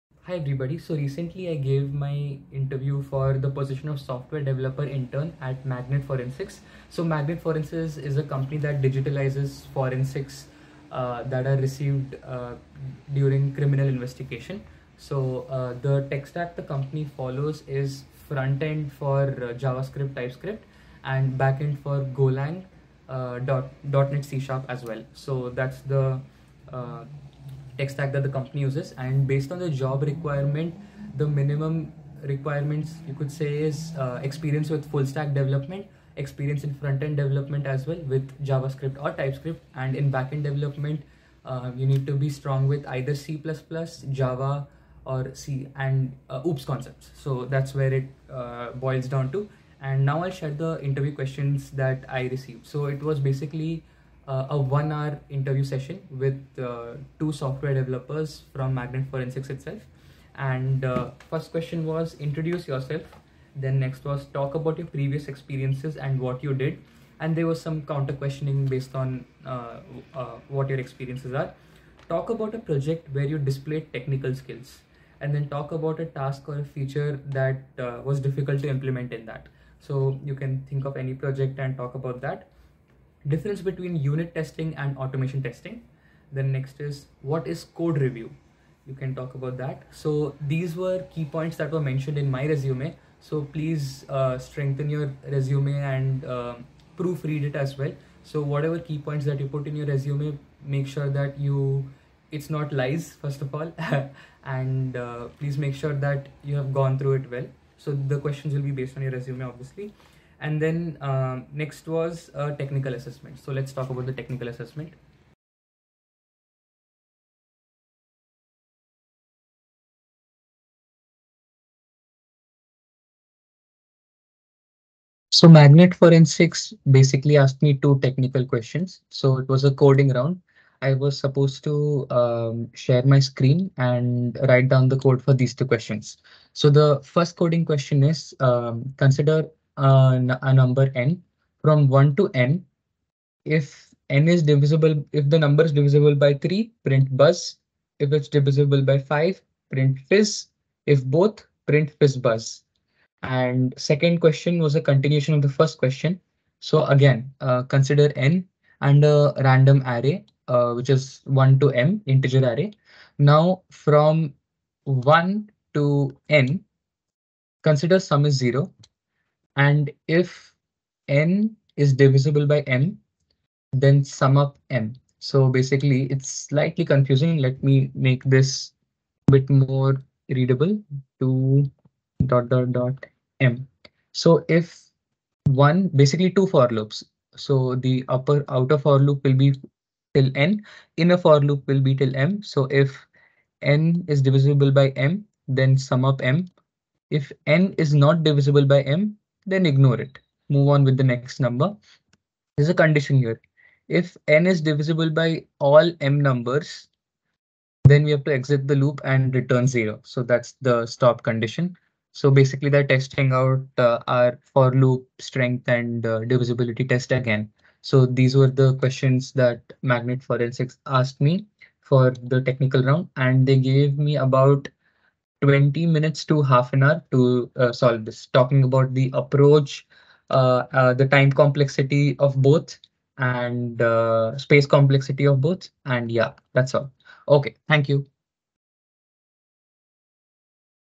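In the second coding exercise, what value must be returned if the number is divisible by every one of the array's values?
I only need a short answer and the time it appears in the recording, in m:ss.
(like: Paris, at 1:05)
0, at 3:29.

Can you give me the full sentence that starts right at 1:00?
And uh, first question was introduce yourself.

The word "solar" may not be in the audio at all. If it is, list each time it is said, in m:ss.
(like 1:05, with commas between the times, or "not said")
not said.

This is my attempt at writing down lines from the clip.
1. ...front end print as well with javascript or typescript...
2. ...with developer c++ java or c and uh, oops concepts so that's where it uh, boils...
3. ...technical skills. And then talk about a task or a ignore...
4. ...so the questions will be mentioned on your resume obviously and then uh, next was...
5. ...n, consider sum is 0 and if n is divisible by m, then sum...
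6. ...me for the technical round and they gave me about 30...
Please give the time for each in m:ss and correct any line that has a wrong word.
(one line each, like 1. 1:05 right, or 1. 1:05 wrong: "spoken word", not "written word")
1. 0:36 wrong: "development", not "print"
2. 0:42 wrong: "either", not "developer"
3. 1:13 wrong: "feature", not "ignore"
4. 1:47 wrong: "based", not "mentioned"
5. 2:46 right
6. 3:41 wrong: "20", not "30".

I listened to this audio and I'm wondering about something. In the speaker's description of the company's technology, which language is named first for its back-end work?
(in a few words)
Golang.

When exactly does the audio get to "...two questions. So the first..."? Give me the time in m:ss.
2:15.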